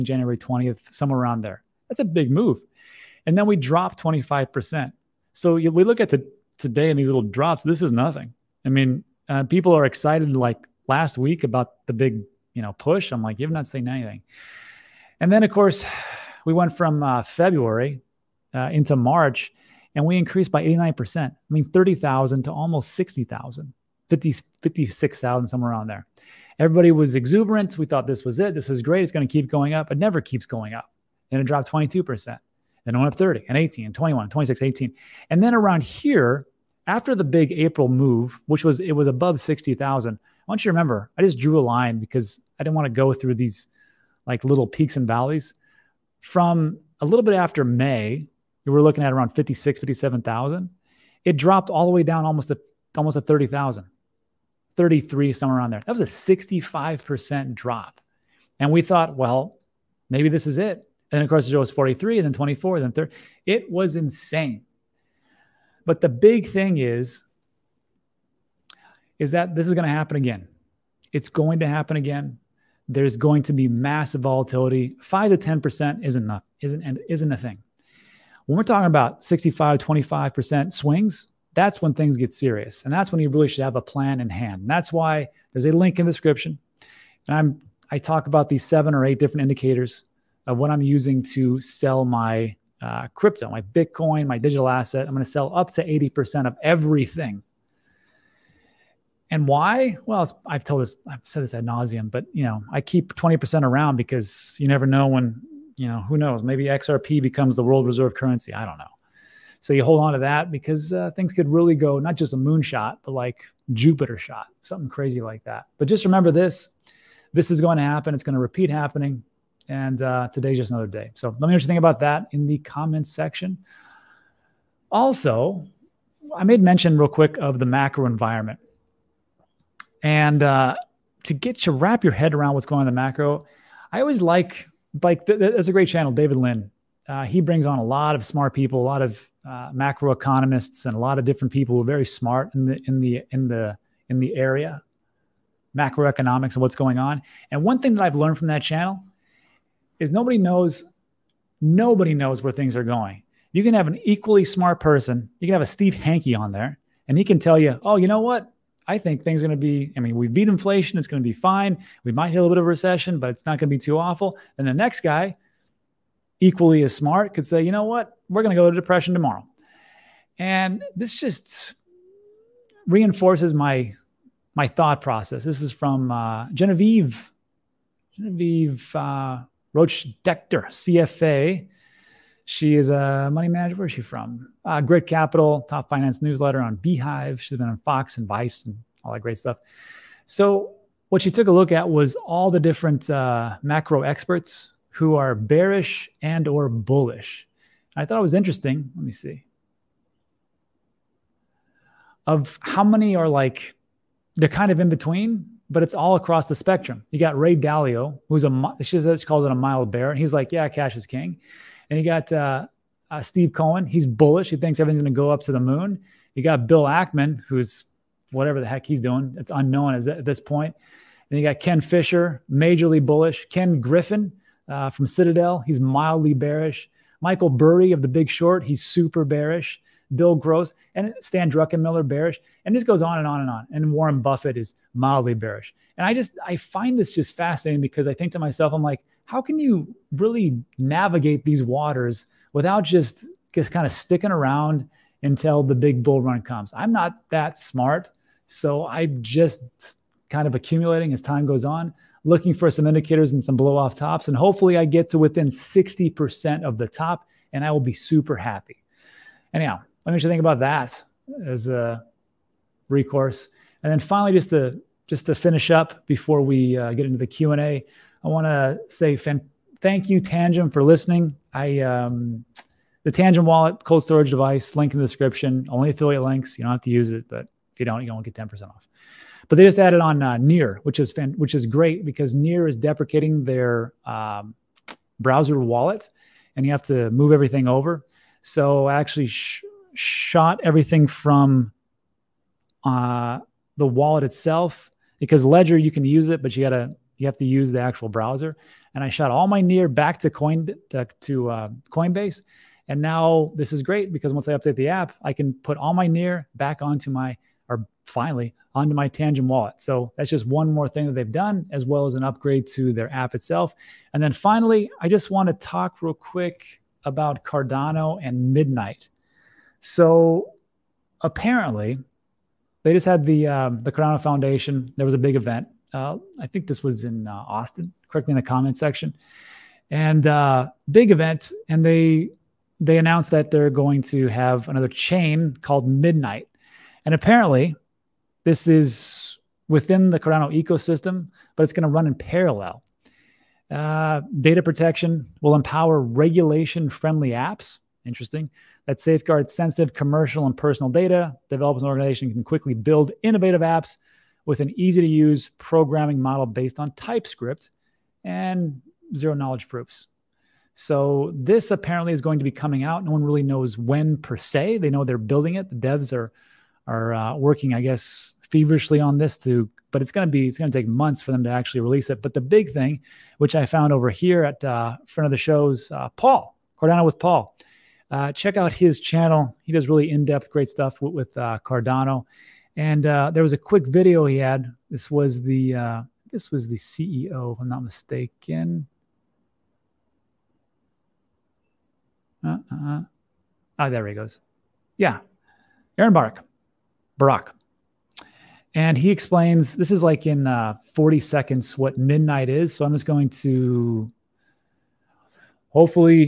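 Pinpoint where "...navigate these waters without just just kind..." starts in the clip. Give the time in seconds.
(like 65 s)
240 s.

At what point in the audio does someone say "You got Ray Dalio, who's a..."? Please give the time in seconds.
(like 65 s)
207 s.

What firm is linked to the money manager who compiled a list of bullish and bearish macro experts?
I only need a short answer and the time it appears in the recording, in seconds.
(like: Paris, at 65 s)
Grit Capital, at 184 s.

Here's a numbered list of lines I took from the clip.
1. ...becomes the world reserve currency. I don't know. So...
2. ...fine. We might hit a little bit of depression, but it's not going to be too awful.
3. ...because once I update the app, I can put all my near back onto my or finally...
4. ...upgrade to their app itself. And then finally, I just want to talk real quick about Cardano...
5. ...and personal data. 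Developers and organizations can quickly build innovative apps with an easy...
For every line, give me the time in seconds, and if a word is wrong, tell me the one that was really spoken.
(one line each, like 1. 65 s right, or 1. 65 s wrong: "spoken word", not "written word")
1. 107 s right
2. 161 s wrong: "recession", not "depression"
3. 304 s right
4. 312 s right
5. 350 s right.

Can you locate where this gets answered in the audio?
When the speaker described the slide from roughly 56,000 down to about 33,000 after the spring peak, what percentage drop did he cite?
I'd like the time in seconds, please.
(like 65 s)
56 s.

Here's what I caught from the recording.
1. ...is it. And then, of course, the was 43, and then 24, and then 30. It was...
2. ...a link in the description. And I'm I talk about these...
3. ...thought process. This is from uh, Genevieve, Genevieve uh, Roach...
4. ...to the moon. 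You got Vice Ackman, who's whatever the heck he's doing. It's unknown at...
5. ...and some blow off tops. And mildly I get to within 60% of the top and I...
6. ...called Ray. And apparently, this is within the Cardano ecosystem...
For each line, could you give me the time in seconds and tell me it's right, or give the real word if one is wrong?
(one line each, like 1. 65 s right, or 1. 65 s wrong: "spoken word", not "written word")
1. 60 s right
2. 85 s right
3. 174 s right
4. 215 s wrong: "Bill", not "Vice"
5. 253 s wrong: "hopefully", not "mildly"
6. 335 s wrong: "Midnight", not "Ray".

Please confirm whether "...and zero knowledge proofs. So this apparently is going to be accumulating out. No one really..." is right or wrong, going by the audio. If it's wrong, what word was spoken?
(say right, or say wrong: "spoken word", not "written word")
wrong: "coming", not "accumulating".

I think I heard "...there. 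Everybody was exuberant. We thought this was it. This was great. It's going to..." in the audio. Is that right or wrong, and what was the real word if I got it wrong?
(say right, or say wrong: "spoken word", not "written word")
right.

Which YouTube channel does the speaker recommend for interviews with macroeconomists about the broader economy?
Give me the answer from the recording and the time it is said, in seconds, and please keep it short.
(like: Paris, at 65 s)
David Lin, at 136 s.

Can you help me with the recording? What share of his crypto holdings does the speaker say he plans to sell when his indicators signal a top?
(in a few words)
80%.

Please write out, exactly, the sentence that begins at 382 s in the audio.
And uh, there was a quick video he had.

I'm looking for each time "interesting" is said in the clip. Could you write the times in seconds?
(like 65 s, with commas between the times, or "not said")
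198 s, 348 s.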